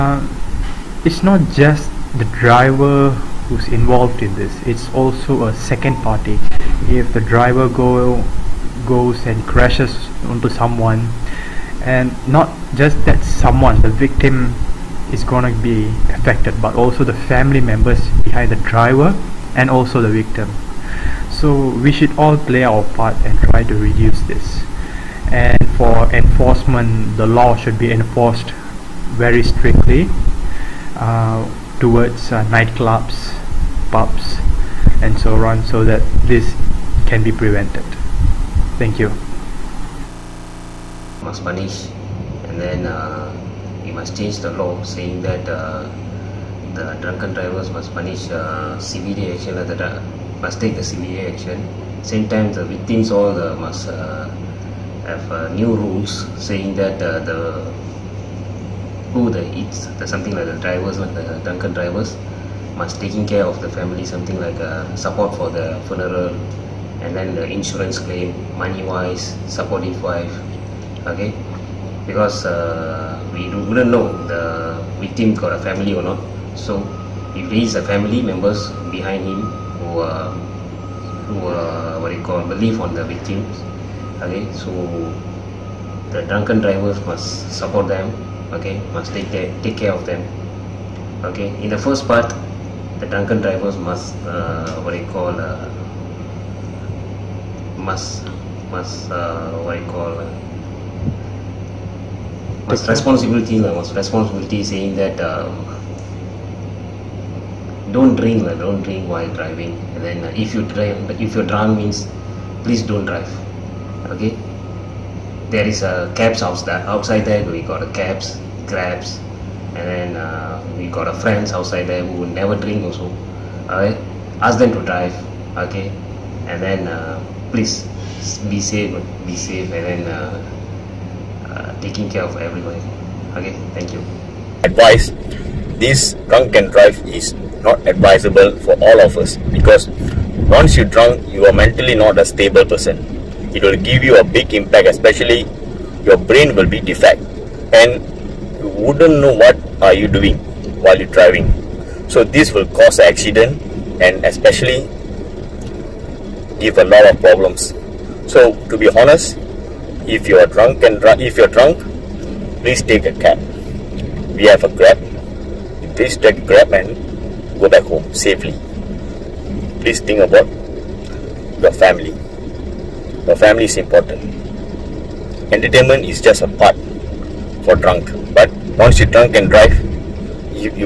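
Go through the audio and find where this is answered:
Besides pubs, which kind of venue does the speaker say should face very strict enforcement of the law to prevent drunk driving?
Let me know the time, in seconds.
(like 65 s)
32 s.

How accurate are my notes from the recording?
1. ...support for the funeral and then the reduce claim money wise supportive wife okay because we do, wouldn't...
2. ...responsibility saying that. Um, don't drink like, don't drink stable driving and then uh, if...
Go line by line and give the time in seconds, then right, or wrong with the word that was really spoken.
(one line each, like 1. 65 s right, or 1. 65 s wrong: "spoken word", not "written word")
1. 64 s wrong: "insurance", not "reduce"
2. 103 s wrong: "while", not "stable".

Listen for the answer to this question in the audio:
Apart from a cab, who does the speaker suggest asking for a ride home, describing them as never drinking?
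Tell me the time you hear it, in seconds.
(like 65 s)
121 s.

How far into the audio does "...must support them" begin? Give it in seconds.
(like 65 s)
87 s.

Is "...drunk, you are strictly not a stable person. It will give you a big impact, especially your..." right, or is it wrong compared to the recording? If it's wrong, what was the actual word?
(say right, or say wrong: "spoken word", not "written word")
wrong: "mentally", not "strictly".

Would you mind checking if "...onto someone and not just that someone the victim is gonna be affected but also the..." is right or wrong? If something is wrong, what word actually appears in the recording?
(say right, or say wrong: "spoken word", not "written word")
right.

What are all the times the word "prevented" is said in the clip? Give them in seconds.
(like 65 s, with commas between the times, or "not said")
37 s.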